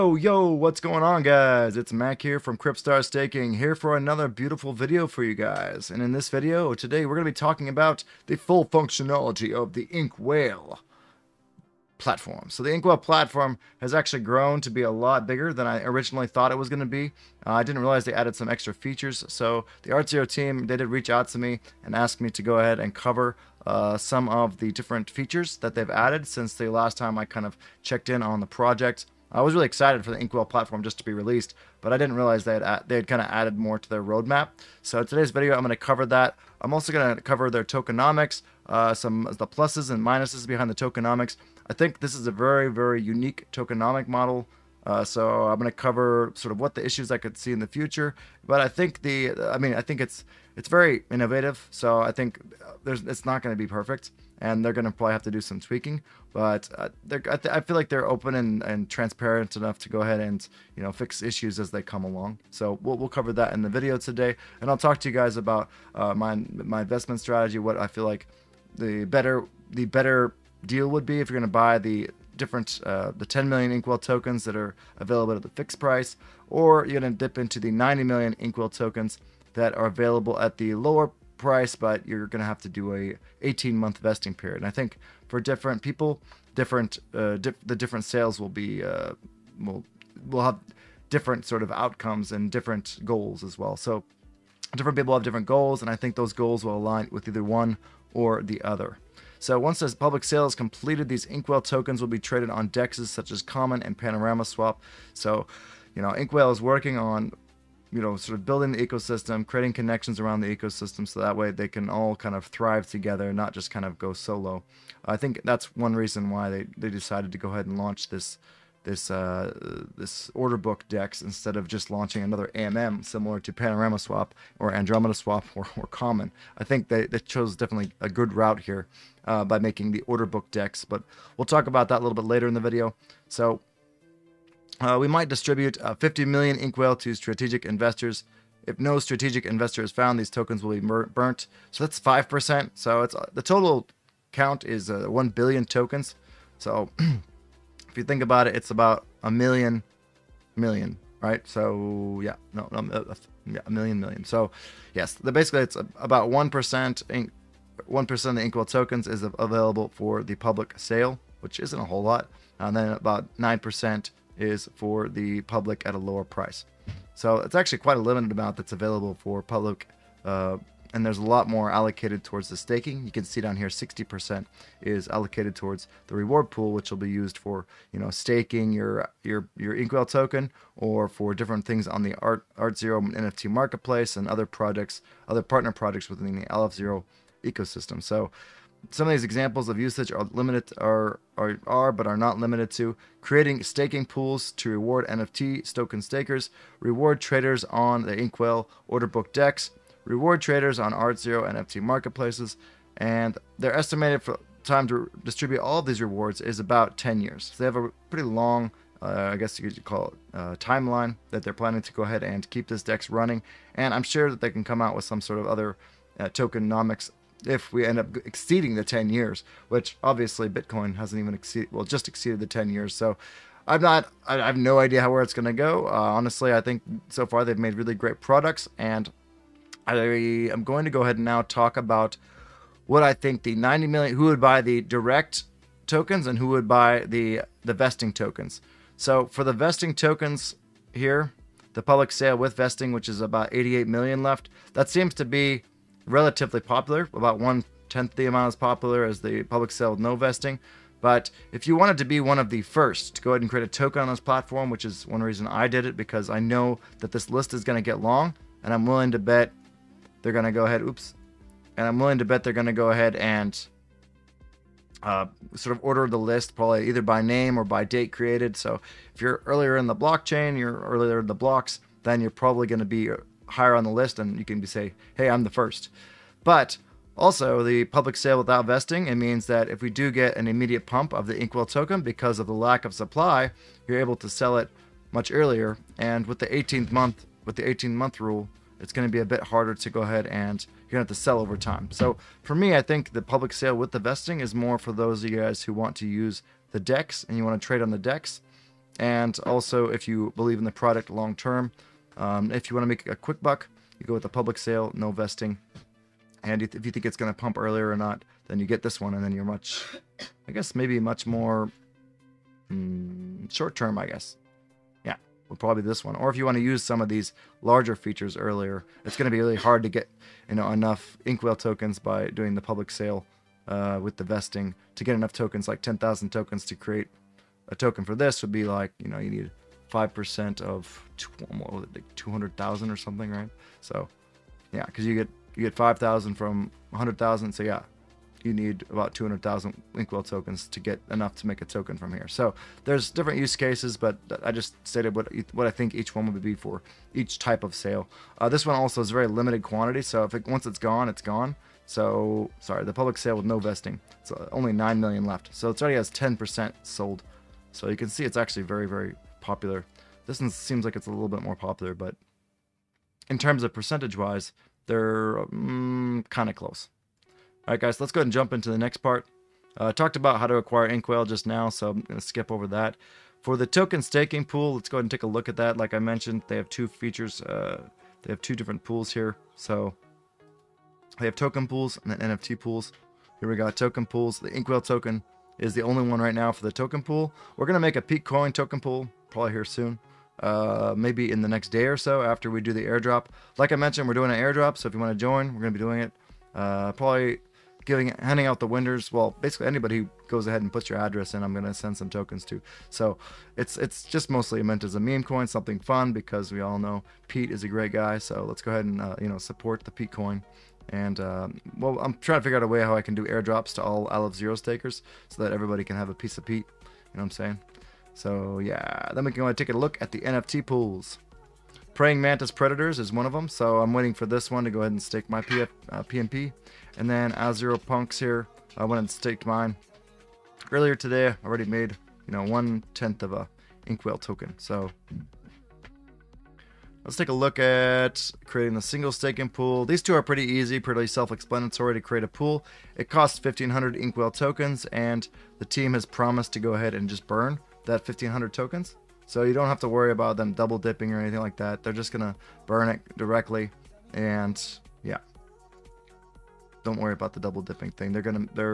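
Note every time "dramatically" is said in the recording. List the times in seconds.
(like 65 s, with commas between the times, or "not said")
not said.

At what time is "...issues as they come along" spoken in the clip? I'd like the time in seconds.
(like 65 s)
61 s.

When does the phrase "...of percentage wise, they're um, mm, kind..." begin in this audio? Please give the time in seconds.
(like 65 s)
363 s.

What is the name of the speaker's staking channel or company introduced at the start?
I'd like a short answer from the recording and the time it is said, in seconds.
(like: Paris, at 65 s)
Kryptstar Staking, at 2 s.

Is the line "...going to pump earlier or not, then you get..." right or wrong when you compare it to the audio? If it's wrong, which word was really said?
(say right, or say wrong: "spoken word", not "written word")
right.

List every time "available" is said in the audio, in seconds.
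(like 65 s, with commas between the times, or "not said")
74 s, 79 s, 159 s, 168 s.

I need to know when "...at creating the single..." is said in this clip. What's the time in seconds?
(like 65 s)
437 s.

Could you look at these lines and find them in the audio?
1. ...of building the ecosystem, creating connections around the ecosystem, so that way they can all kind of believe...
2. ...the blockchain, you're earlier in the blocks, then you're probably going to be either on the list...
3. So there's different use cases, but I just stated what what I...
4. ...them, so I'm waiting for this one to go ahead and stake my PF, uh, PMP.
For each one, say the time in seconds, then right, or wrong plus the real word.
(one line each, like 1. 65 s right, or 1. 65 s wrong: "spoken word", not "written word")
1. 108 s wrong: "thrive", not "believe"
2. 269 s wrong: "higher", not "either"
3. 342 s right
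4. 423 s right.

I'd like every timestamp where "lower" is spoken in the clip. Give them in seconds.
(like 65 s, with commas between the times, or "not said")
80 s, 165 s.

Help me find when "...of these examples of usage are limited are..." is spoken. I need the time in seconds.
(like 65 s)
189 s.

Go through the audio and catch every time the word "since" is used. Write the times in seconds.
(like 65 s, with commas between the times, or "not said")
26 s.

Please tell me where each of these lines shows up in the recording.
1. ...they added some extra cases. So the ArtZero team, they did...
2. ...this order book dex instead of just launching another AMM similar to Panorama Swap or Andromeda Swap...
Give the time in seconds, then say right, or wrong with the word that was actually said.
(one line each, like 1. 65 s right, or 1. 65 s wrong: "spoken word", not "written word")
1. 18 s wrong: "features", not "cases"
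2. 119 s right.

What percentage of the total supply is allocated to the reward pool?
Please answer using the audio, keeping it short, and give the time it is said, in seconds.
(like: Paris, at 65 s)
60%, at 173 s.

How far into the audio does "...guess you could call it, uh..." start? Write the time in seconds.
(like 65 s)
209 s.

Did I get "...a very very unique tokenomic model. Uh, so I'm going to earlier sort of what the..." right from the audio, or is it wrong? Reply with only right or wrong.
wrong.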